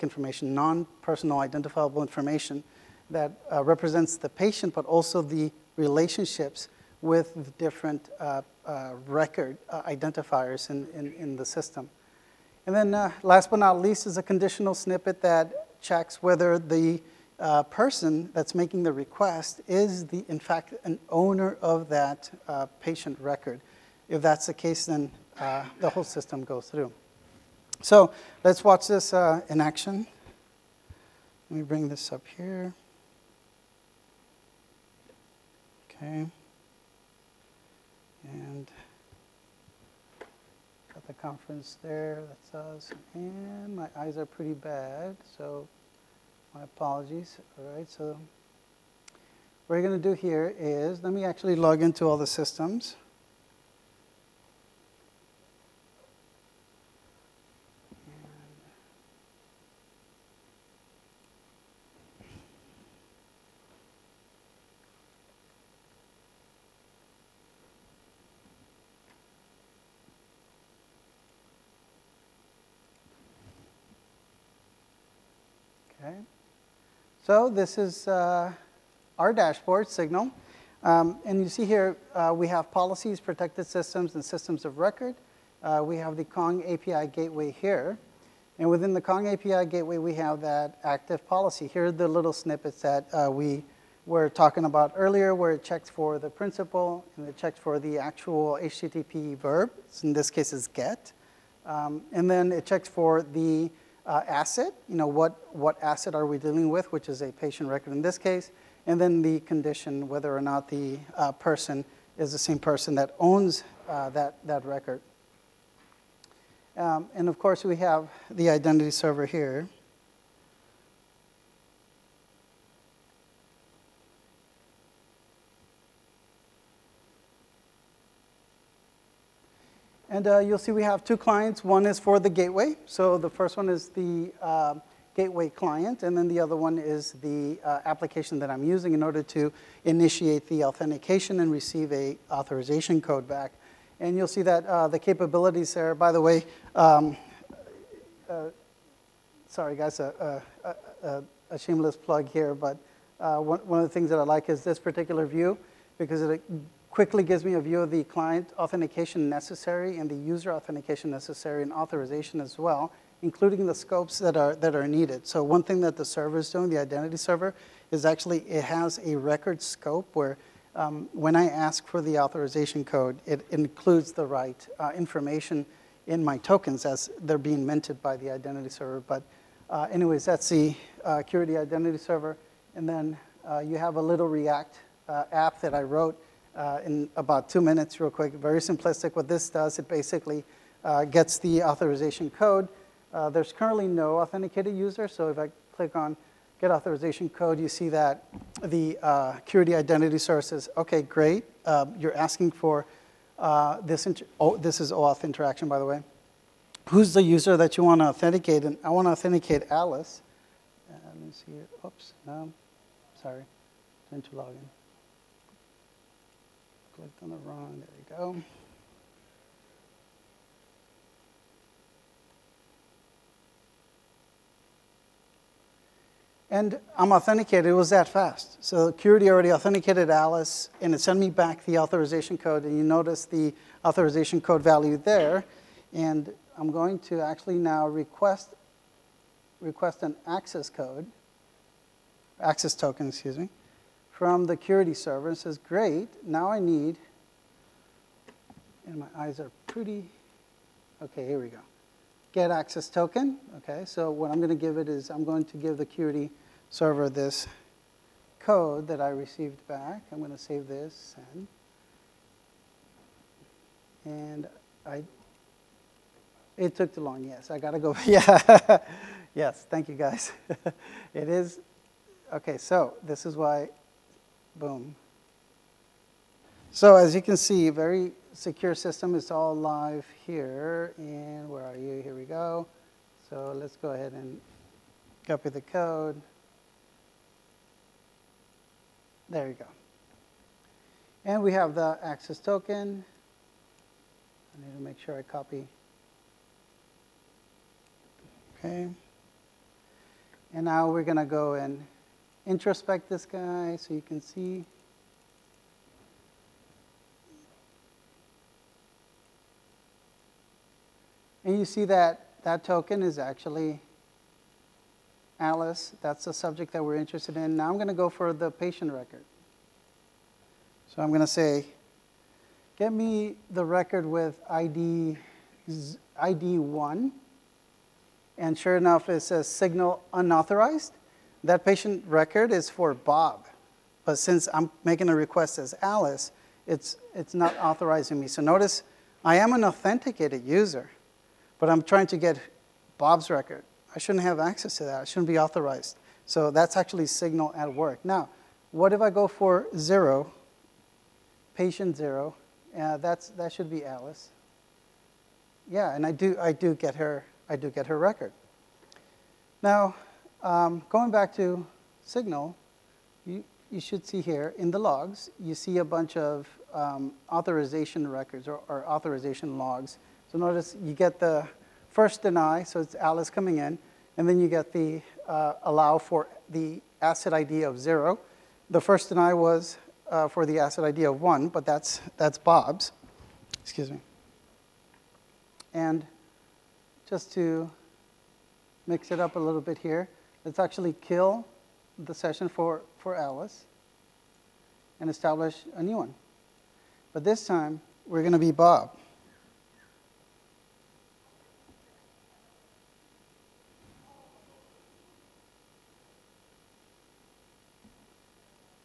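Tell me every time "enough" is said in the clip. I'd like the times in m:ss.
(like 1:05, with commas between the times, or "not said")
5:28.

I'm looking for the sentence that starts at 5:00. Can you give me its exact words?
And now we're going to go and introspect this guy so you can see.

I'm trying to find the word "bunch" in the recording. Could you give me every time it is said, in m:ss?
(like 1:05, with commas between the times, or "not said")
6:05.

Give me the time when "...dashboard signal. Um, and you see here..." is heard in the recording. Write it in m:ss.
1:19.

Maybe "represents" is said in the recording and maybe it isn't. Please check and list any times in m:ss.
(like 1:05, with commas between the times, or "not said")
0:03.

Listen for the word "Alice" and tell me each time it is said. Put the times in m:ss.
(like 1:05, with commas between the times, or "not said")
3:29, 3:50, 5:15, 5:35, 5:53, 6:12, 6:33.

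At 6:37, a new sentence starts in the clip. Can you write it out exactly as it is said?
But this time, we're going to be Bob.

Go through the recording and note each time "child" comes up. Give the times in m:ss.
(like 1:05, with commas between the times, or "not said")
not said.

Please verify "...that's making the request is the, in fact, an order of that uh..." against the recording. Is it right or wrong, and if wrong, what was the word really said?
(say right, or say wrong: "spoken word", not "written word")
wrong: "owner", not "order".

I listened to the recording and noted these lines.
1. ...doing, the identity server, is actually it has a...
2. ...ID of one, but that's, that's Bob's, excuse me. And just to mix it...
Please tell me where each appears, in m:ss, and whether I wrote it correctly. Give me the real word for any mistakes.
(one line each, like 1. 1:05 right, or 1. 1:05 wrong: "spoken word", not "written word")
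1. 2:46 right
2. 6:20 right.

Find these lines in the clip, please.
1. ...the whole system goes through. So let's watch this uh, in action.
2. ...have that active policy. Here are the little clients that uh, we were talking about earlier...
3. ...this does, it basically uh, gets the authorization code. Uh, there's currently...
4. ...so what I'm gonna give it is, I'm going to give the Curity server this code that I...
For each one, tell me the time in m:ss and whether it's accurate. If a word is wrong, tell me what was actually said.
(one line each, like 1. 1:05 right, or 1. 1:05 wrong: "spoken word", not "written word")
1. 0:25 right
2. 1:30 wrong: "snippets", not "clients"
3. 3:09 right
4. 4:13 right.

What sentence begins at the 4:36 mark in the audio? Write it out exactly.
So as you can see, very secure system.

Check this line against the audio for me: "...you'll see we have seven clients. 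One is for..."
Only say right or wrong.
wrong.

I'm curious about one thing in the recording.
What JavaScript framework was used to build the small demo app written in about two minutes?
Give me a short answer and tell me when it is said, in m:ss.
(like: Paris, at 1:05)
React, at 3:04.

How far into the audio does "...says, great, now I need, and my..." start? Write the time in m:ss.
4:05.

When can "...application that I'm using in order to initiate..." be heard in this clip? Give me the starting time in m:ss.
2:17.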